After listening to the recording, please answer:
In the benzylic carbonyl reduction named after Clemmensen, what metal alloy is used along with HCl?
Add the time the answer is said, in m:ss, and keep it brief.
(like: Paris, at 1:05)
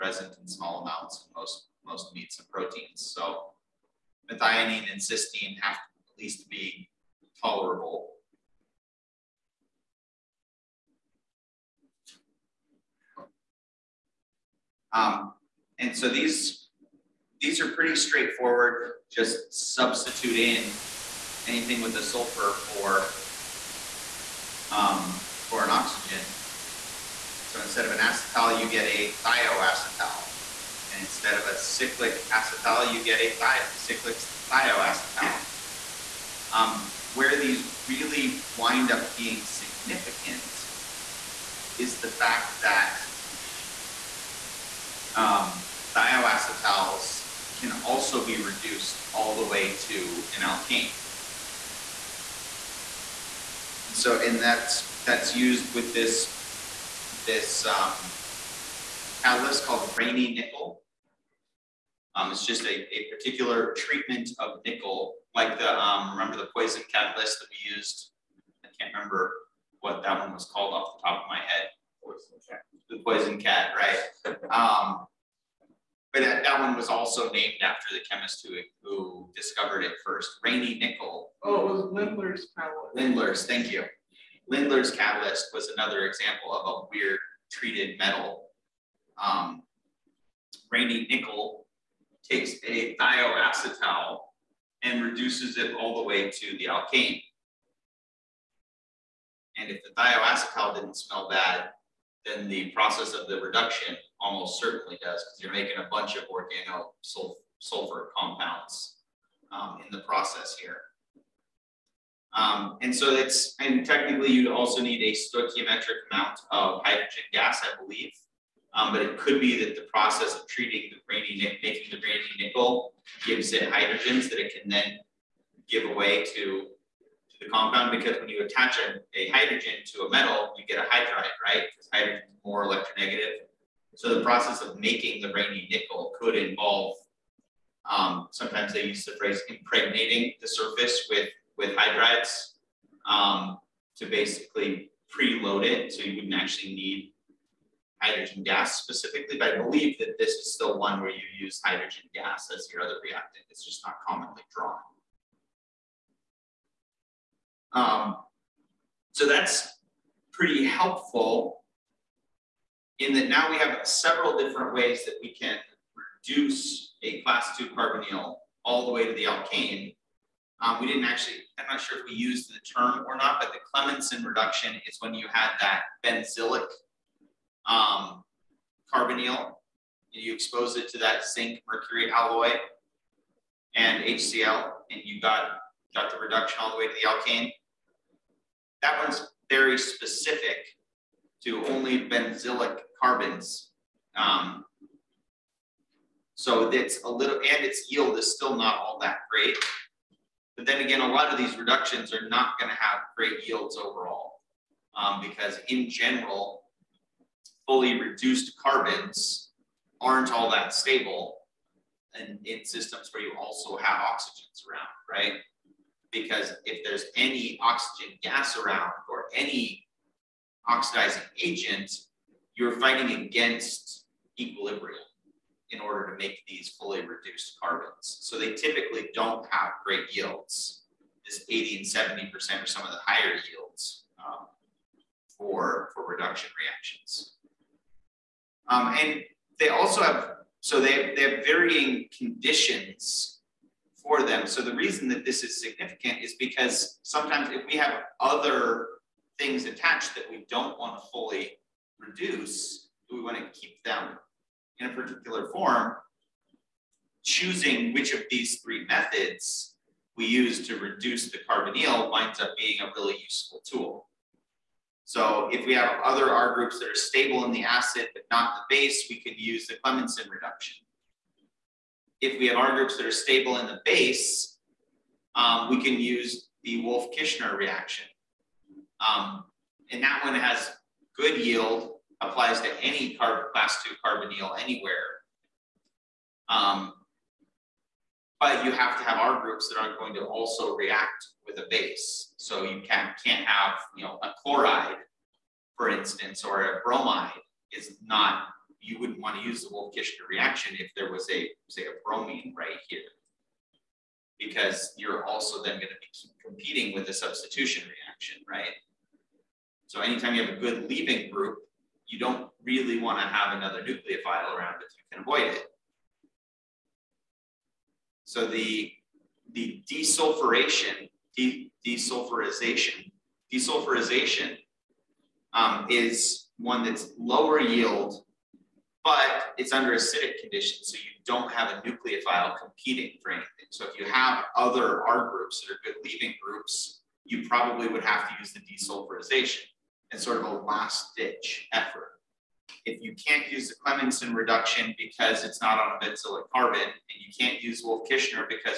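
zinc mercury alloy, at 3:01.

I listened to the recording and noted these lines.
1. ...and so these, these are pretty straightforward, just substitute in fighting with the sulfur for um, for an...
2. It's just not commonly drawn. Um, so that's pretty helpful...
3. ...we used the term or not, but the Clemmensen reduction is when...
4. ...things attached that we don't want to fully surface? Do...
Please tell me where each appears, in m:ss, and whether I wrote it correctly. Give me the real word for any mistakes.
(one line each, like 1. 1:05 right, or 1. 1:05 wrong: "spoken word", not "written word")
1. 0:15 wrong: "anything", not "fighting"
2. 2:33 right
3. 2:52 right
4. 4:09 wrong: "reduce", not "surface".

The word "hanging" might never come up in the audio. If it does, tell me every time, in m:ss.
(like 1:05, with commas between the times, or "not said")
not said.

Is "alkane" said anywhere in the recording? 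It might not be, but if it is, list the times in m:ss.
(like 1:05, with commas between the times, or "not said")
0:50, 1:36, 2:49, 3:07.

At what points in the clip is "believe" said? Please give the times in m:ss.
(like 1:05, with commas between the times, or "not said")
1:57, 2:29.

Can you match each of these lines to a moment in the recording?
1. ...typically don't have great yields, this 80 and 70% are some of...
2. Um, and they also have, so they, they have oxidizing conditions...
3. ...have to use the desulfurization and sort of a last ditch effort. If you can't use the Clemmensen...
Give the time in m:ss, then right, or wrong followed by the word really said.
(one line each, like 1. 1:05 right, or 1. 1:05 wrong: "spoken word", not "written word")
1. 3:48 right
2. 3:58 wrong: "varying", not "oxidizing"
3. 5:38 right.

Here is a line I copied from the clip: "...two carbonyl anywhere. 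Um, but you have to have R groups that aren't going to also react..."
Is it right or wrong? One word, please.
right.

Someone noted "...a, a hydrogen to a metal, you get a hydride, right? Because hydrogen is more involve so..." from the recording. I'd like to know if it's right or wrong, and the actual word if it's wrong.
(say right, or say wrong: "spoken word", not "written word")
wrong: "electronegative", not "involve".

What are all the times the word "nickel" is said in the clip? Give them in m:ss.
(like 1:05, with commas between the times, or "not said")
1:00, 1:04, 1:20, 1:31, 2:02, 2:15.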